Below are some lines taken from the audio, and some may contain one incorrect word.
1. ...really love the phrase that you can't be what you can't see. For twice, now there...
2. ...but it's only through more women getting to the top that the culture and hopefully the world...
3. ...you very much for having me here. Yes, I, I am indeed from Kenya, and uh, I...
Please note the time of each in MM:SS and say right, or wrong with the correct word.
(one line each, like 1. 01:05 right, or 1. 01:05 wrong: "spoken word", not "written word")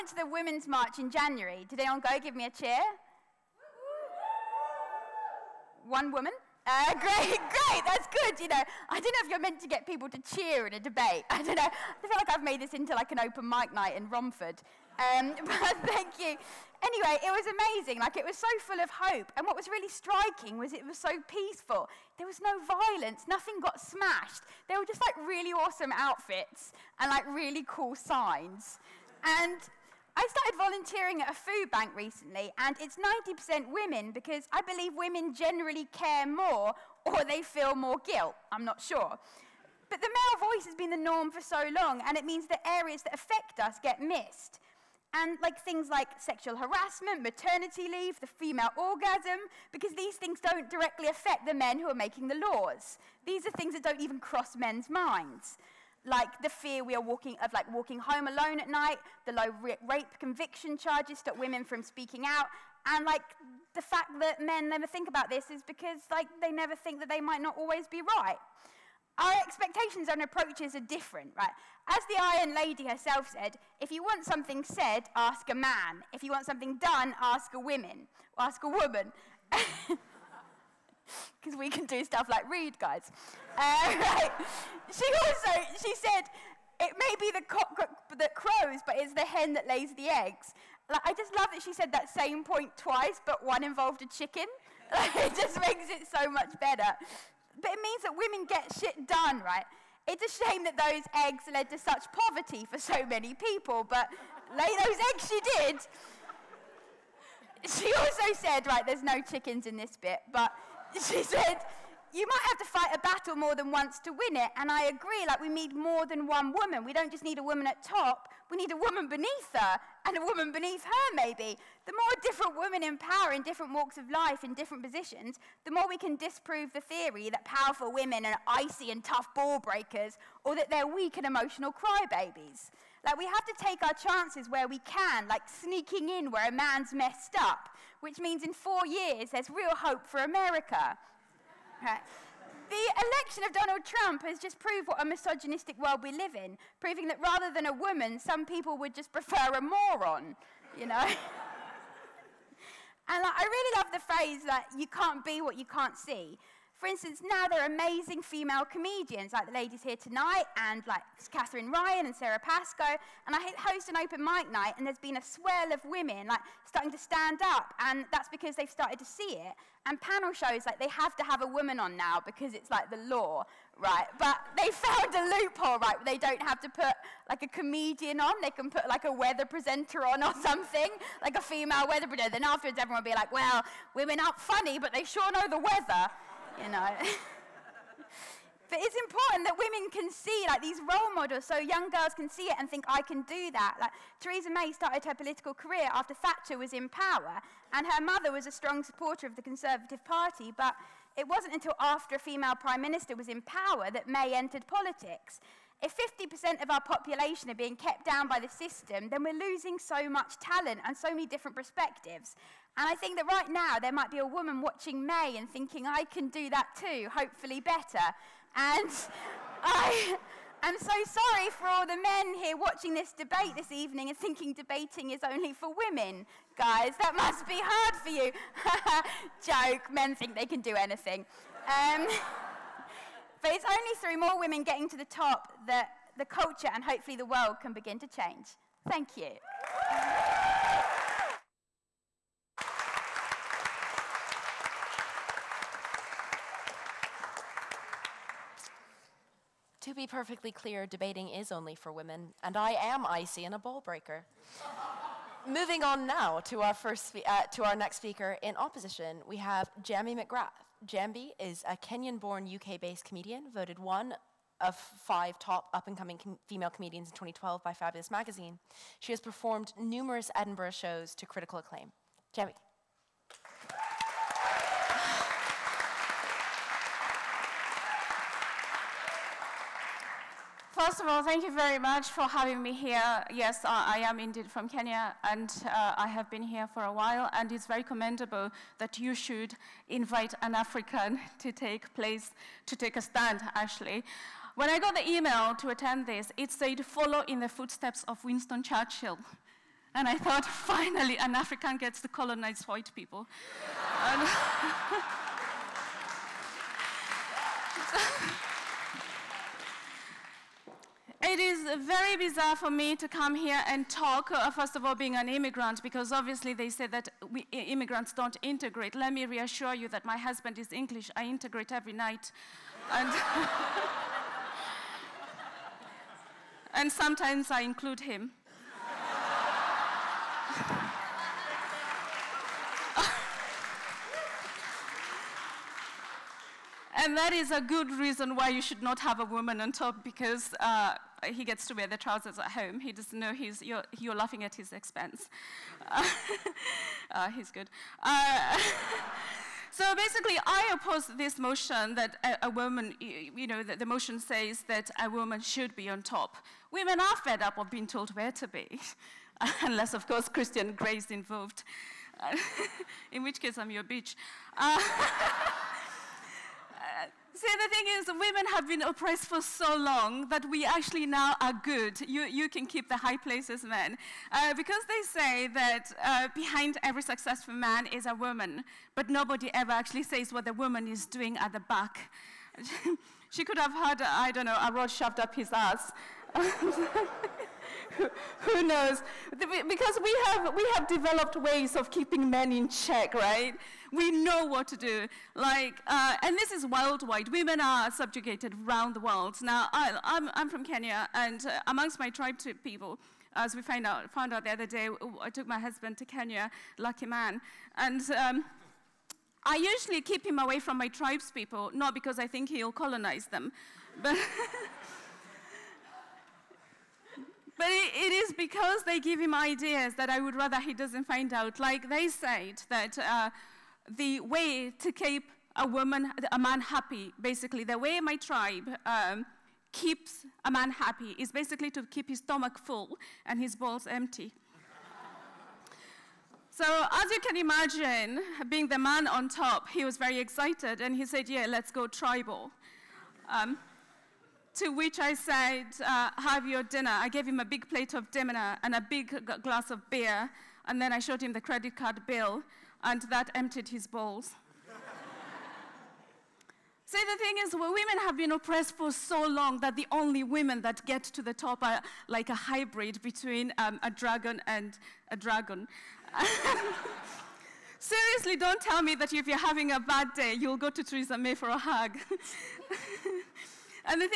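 1. 02:33 wrong: "instance", not "twice"
2. 03:53 right
3. 04:41 right.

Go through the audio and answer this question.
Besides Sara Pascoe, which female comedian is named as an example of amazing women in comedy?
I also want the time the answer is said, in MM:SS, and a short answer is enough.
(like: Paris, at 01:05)
Katherine Ryan, at 02:41.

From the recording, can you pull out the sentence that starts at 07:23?
Um, to which I said, uh, have your dinner.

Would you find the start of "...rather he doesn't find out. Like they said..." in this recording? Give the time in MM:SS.
07:00.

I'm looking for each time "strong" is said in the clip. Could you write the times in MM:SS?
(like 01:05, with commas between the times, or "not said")
03:18.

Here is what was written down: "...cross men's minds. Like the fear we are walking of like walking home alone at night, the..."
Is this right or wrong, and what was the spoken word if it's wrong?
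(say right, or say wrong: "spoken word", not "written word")
right.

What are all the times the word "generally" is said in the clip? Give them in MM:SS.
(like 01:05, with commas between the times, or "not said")
00:35.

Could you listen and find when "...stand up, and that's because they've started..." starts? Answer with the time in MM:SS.
02:46.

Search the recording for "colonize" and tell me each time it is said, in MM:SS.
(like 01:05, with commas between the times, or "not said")
05:02, 06:52.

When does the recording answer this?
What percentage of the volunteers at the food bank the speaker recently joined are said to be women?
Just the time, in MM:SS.
00:32.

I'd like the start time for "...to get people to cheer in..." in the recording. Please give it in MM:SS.
00:09.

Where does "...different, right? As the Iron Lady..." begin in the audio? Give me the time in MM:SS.
01:10.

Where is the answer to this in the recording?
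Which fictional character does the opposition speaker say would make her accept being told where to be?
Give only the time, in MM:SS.
06:00.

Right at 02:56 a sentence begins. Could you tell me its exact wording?
They don't have to put like a comedian on.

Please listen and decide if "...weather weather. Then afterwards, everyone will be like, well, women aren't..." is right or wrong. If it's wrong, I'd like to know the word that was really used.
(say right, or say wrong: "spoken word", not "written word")
wrong: "presenter", not "weather".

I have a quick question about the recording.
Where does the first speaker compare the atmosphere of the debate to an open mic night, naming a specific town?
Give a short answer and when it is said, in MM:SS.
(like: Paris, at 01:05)
Romford, at 00:14.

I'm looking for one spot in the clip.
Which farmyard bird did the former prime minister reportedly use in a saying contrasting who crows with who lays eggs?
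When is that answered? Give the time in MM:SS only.
01:29.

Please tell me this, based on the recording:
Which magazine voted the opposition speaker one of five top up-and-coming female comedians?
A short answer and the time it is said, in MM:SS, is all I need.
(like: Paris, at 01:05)
Fabulous Magazine, at 04:27.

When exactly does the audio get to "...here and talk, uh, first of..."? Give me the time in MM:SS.
05:13.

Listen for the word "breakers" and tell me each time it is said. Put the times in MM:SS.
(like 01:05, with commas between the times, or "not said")
02:09, 04:13.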